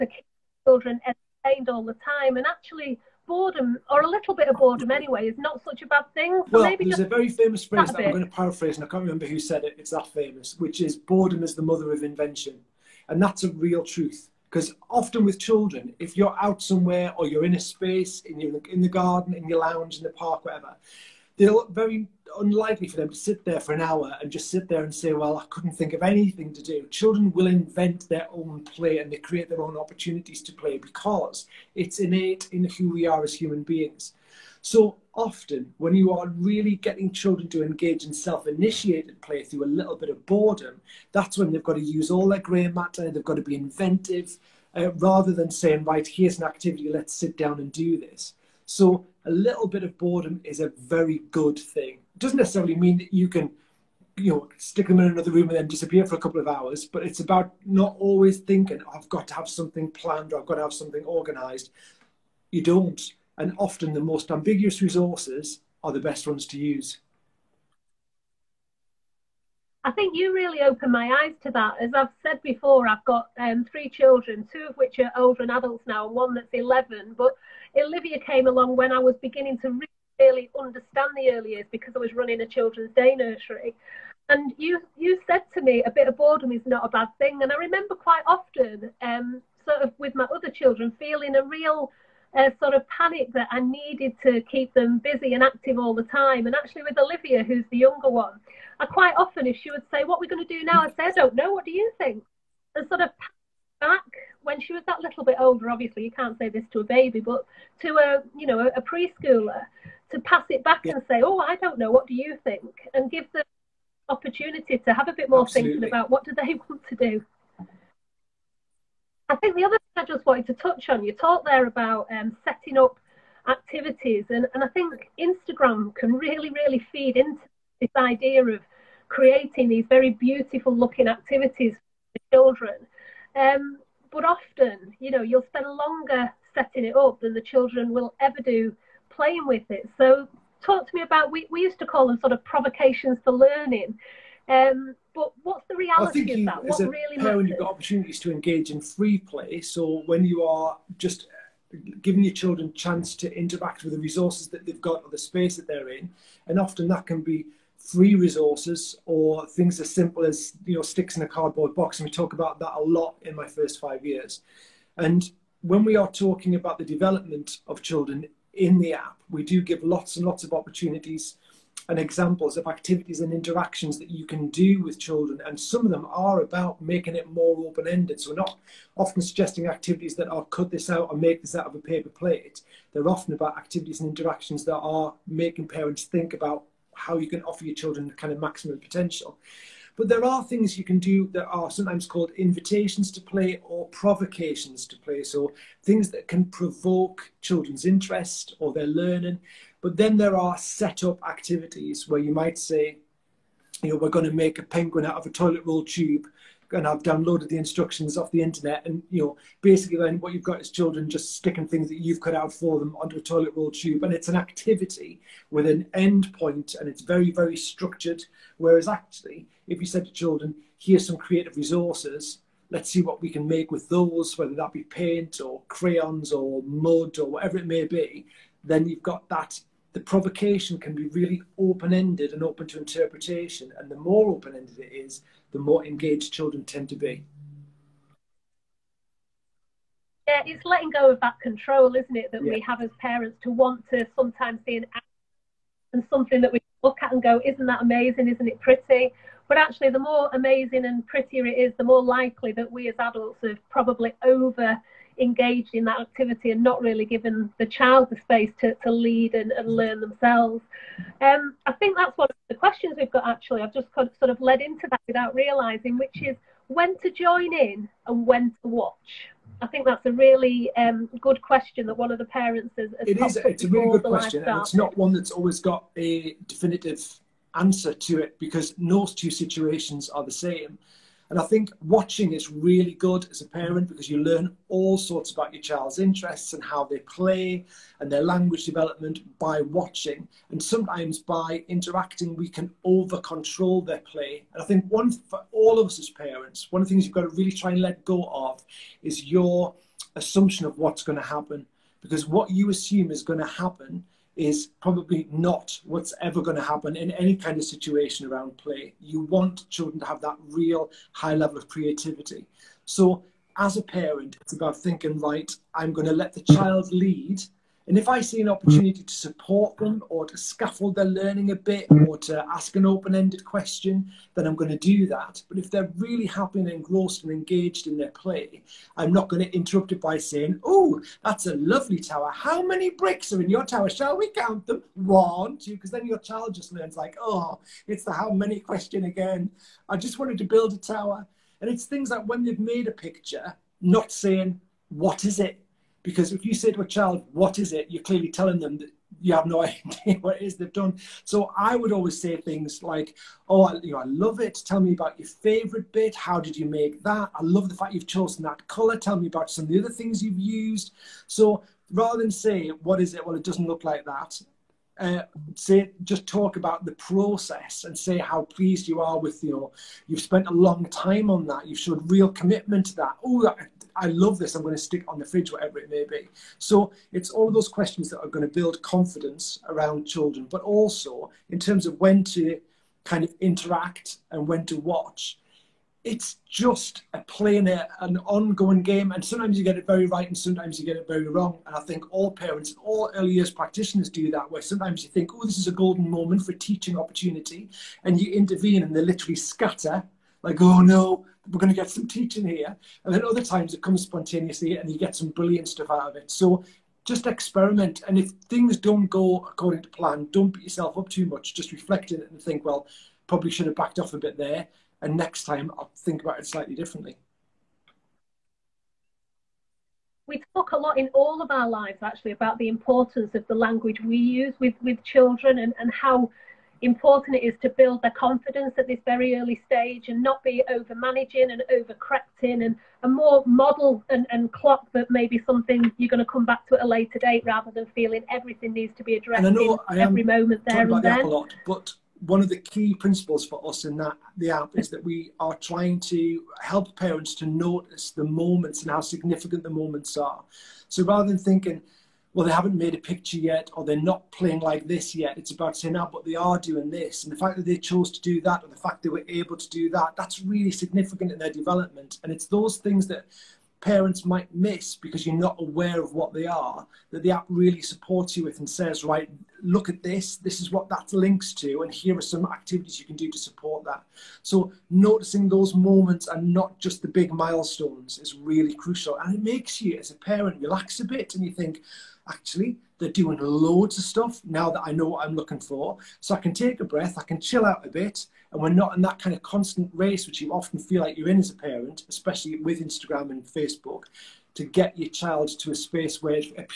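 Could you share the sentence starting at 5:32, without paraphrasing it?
How many bricks are in your tower?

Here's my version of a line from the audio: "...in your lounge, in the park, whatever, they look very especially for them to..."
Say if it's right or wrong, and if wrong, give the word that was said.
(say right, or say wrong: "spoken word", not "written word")
wrong: "unlikely", not "especially".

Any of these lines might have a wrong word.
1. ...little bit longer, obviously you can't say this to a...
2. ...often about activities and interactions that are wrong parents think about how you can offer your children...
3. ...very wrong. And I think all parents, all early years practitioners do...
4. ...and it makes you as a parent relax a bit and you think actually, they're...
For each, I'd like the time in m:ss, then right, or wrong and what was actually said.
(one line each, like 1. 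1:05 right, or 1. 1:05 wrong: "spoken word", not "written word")
1. 1:45 wrong: "older", not "longer"
2. 3:03 wrong: "making", not "wrong"
3. 6:31 right
4. 7:59 right.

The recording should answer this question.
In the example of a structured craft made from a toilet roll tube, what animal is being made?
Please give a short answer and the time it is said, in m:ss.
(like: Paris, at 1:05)
penguin, at 3:24.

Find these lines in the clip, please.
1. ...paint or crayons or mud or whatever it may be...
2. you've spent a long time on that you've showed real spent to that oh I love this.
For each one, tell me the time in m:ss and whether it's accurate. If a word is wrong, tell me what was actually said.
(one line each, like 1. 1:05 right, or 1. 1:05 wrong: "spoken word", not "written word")
1. 3:44 right
2. 6:10 wrong: "commitment", not "spent".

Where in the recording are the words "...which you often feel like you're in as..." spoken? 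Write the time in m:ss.
8:10.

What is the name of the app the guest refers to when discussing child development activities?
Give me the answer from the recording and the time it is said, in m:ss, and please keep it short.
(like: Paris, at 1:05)
My First Five Years, at 2:43.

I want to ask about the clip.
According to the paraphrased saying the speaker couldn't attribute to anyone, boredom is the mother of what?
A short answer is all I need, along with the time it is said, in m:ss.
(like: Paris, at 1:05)
invention, at 0:12.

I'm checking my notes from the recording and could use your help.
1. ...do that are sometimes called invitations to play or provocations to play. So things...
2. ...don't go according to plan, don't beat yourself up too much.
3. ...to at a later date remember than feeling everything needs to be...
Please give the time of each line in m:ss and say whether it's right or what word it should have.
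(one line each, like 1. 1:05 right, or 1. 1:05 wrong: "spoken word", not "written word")
1. 3:10 right
2. 6:48 right
3. 7:16 wrong: "rather", not "remember".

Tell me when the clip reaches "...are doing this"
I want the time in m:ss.
7:36.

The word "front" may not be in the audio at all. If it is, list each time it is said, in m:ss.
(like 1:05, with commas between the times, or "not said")
not said.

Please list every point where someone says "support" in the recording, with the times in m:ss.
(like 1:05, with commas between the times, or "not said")
5:19, 7:47, 7:53.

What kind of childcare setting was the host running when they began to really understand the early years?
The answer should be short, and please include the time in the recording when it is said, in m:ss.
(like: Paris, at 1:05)
children's day nursery, at 1:22.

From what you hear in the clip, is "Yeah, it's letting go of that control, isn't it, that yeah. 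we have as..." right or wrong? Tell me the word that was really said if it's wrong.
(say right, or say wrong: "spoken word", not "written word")
right.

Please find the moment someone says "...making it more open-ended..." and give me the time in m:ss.
2:56.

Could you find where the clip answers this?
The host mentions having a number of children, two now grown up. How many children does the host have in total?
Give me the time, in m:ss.
1:13.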